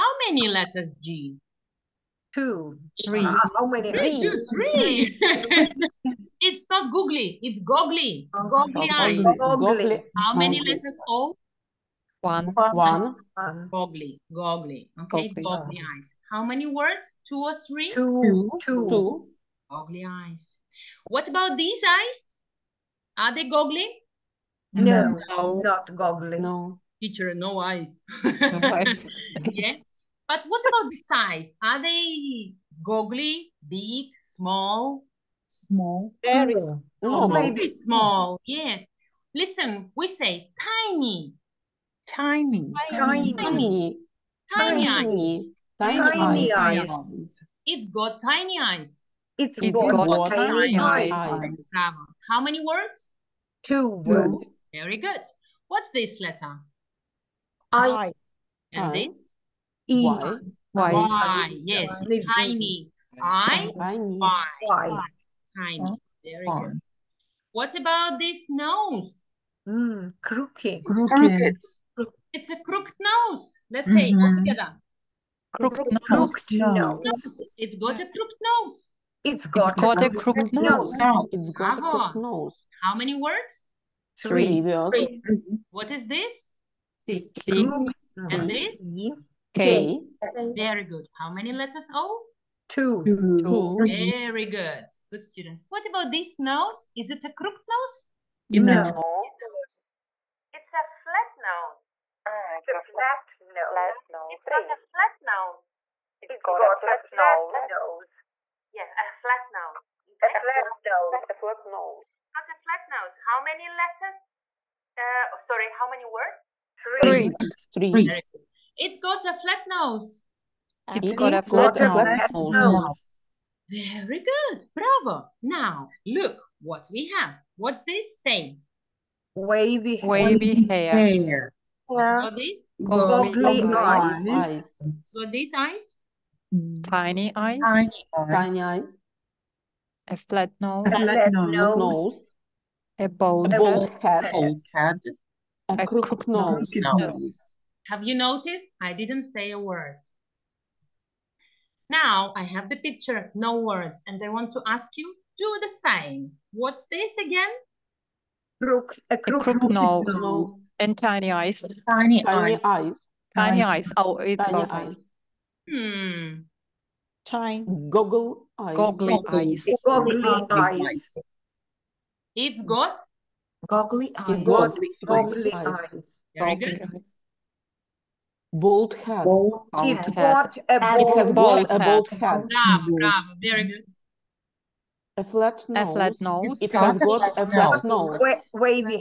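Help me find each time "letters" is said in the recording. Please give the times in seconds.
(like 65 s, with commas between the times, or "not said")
0 s, 10 s, 56 s, 91 s, 113 s.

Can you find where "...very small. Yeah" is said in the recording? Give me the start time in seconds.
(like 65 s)
37 s.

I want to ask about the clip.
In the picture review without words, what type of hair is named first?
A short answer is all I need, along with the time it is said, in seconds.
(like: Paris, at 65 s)
wavy, at 130 s.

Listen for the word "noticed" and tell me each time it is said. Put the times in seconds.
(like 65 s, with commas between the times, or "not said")
148 s.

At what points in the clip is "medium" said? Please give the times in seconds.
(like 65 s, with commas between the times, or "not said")
not said.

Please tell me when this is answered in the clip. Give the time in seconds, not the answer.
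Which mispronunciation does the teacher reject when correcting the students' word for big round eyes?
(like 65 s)
6 s.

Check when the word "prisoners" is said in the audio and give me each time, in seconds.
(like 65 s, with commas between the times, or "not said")
not said.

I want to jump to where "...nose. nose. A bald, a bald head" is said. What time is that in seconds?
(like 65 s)
141 s.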